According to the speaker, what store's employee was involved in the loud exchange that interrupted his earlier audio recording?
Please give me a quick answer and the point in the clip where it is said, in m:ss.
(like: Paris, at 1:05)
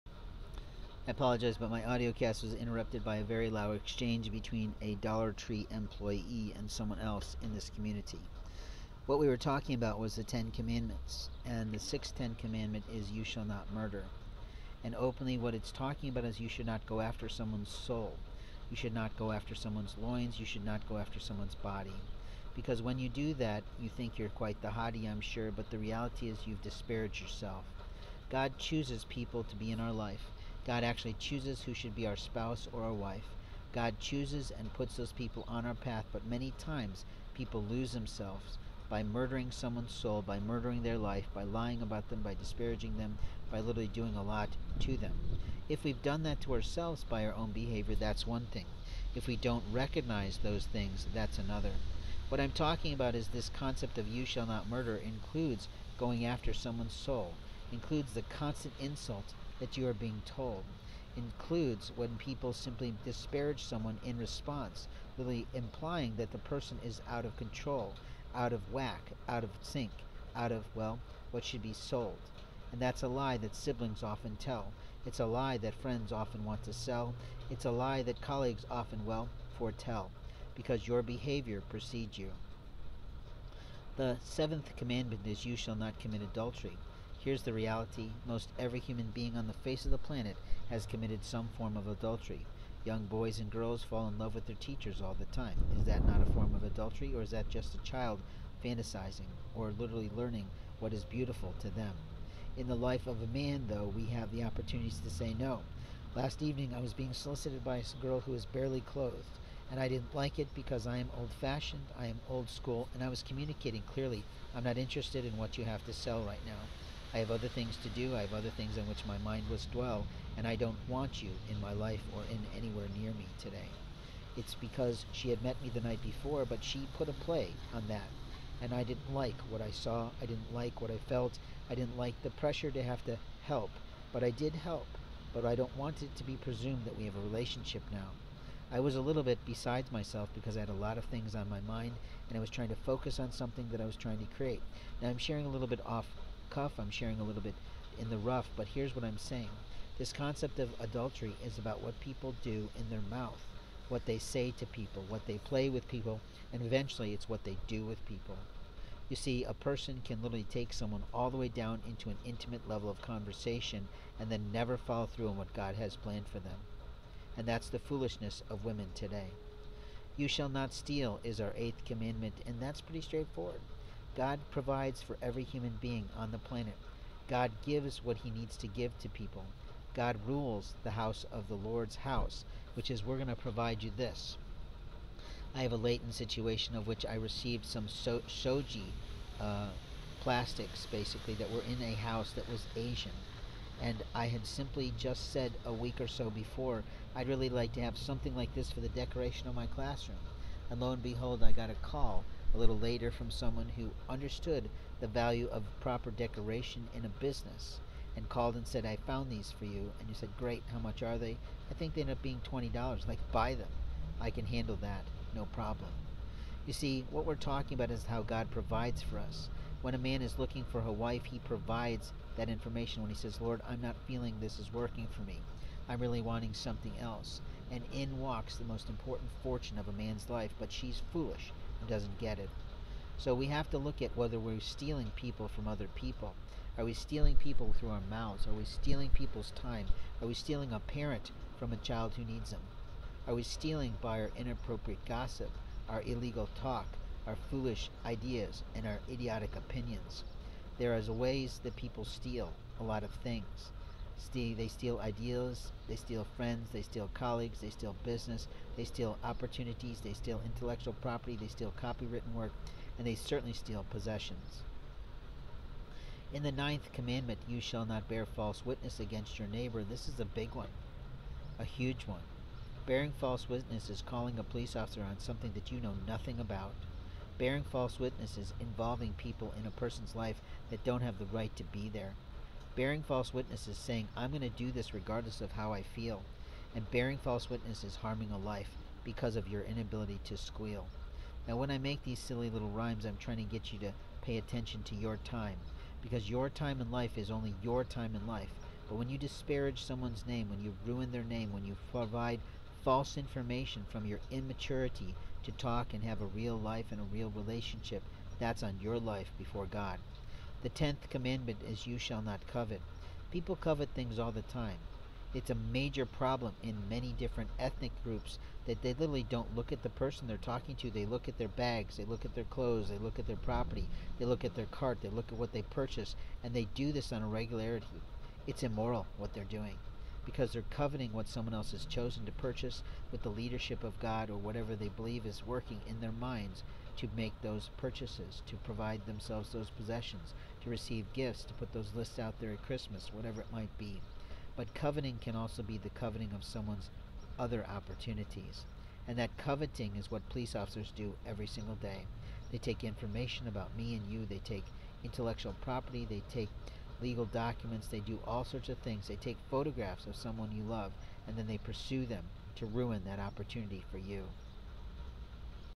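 Dollar Tree, at 0:04.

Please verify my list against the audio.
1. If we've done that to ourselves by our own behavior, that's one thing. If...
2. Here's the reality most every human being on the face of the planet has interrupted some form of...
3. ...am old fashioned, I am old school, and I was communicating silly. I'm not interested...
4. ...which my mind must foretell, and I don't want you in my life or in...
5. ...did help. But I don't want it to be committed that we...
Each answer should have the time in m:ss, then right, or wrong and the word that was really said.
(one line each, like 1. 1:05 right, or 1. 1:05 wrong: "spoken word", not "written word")
1. 0:45 right
2. 1:27 wrong: "committed", not "interrupted"
3. 1:50 wrong: "clearly", not "silly"
4. 1:58 wrong: "dwell", not "foretell"
5. 2:14 wrong: "presumed", not "committed".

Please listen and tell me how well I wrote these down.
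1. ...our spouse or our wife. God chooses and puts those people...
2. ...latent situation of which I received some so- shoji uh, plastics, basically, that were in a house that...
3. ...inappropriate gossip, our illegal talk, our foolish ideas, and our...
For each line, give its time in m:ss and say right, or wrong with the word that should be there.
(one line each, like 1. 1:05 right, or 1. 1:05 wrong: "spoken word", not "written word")
1. 0:32 right
2. 3:05 right
3. 4:04 right.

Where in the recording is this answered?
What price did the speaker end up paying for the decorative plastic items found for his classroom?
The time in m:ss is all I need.
3:32.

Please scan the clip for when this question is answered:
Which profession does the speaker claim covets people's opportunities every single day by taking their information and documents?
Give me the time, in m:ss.
5:50.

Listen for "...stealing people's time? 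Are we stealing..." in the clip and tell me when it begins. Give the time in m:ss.
3:58.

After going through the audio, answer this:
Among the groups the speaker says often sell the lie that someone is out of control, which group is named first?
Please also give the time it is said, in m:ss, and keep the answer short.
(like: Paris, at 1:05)
siblings, at 1:13.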